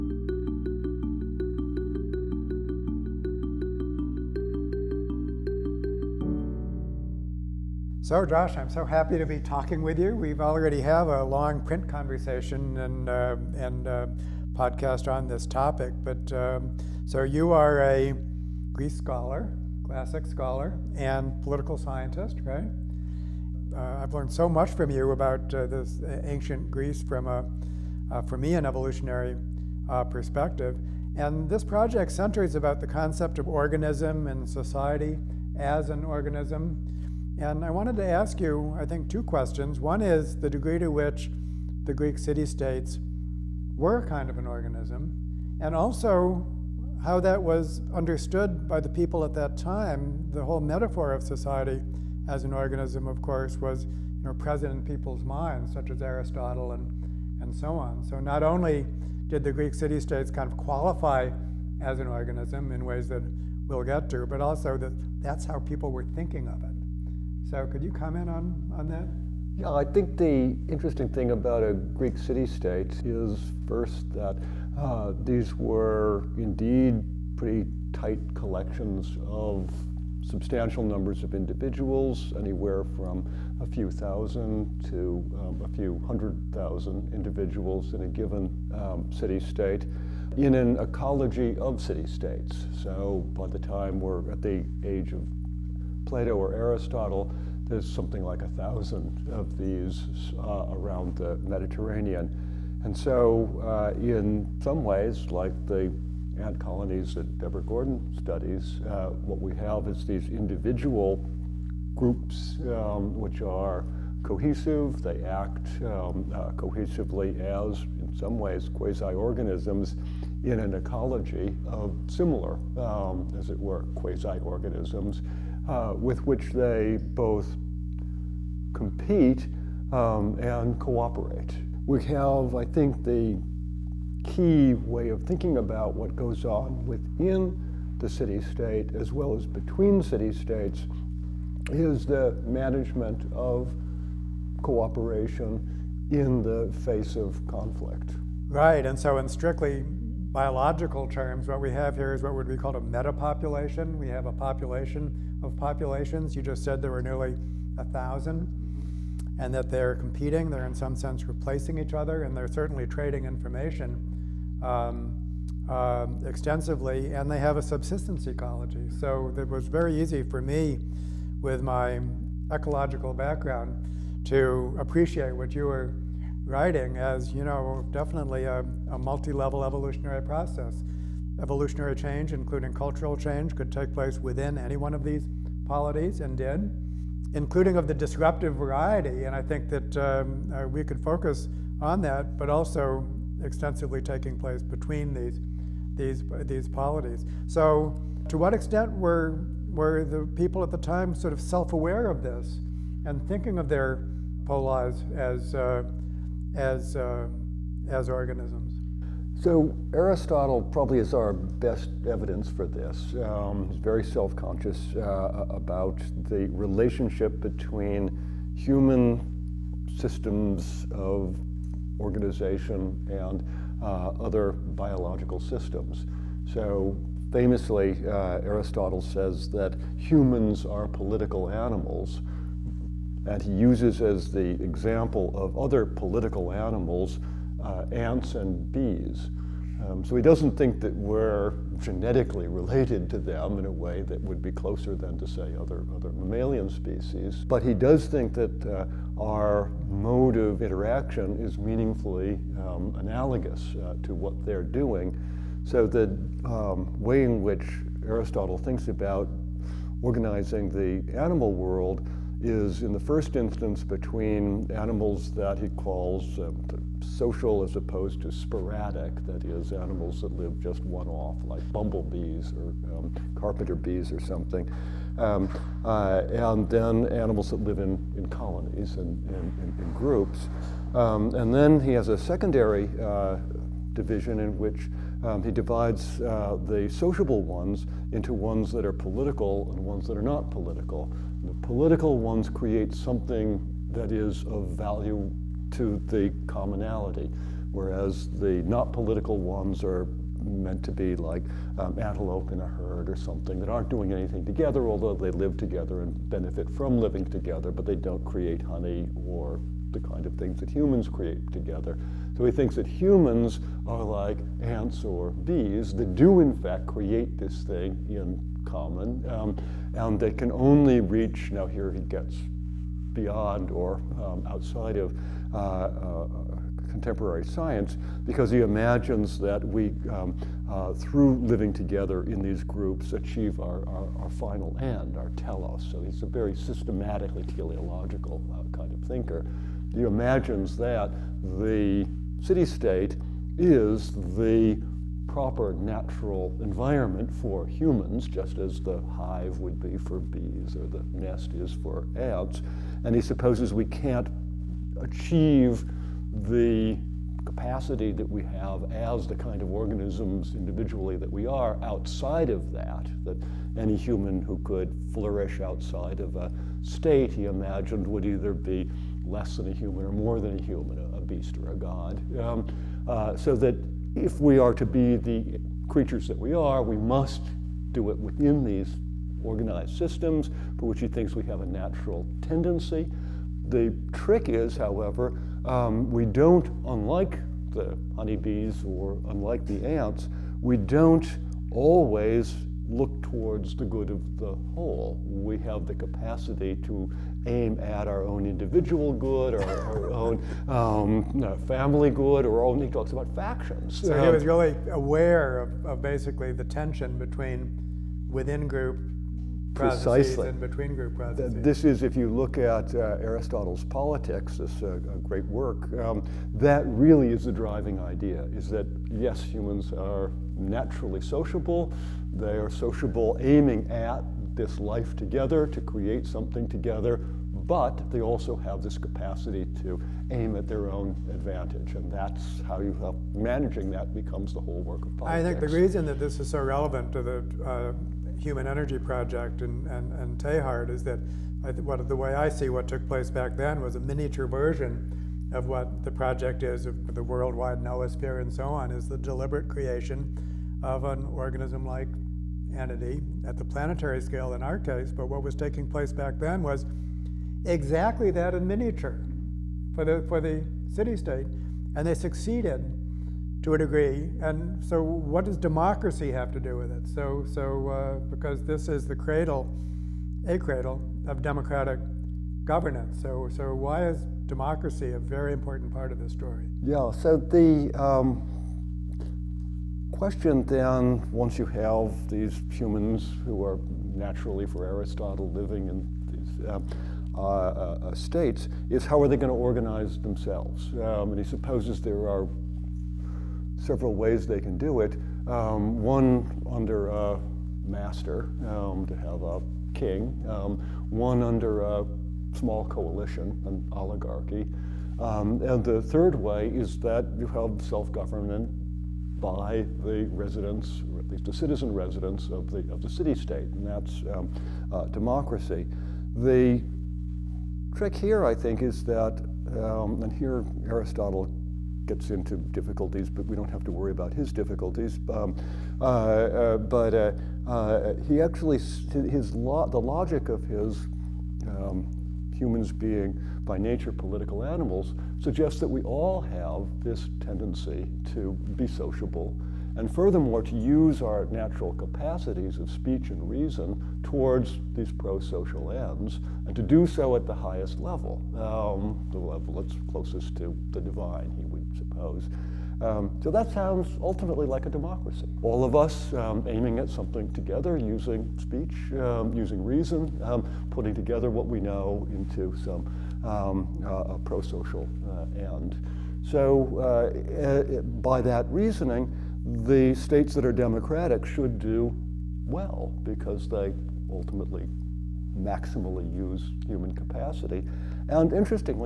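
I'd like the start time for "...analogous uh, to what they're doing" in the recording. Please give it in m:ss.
4:12.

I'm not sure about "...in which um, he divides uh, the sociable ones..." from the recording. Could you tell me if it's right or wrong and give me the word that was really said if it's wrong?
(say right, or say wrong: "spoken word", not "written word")
right.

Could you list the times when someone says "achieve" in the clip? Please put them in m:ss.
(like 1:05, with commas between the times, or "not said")
5:33, 5:55.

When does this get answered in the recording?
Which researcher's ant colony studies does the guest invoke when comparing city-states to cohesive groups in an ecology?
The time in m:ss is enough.
1:47.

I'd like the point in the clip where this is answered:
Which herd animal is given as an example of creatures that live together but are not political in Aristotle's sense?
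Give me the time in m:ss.
5:01.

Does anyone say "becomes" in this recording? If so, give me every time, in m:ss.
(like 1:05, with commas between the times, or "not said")
7:14.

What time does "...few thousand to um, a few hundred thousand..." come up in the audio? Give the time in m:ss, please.
1:23.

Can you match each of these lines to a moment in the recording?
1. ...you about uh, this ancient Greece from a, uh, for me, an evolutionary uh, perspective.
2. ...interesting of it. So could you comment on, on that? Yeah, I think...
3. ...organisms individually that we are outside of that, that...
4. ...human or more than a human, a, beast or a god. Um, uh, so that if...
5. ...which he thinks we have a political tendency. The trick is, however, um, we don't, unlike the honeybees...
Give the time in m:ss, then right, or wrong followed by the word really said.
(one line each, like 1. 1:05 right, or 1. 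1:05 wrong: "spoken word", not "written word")
1. 0:24 right
2. 1:06 wrong: "thinking", not "interesting"
3. 5:59 right
4. 6:09 right
5. 6:20 wrong: "natural", not "political".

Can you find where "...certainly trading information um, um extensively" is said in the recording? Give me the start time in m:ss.
2:42.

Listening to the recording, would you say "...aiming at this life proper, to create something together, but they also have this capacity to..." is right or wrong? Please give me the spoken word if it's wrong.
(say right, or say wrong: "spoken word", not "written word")
wrong: "together", not "proper".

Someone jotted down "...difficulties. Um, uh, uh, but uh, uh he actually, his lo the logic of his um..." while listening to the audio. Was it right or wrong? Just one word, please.
right.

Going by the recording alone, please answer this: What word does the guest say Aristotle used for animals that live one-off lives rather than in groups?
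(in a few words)
Sporadic.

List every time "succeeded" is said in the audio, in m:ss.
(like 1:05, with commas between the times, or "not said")
7:42.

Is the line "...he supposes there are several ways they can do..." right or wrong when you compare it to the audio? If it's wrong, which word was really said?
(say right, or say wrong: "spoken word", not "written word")
right.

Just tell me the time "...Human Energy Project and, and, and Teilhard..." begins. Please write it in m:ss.
7:18.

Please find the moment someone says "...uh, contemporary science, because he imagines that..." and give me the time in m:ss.
5:25.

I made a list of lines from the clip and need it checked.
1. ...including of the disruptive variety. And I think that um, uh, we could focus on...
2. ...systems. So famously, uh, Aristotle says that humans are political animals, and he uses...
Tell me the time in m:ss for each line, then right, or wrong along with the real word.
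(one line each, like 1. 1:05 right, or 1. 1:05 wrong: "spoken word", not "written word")
1. 3:07 right
2. 3:45 right.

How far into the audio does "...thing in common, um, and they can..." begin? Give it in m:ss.
5:17.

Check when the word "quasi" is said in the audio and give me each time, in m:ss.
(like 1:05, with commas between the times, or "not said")
1:58, 2:03.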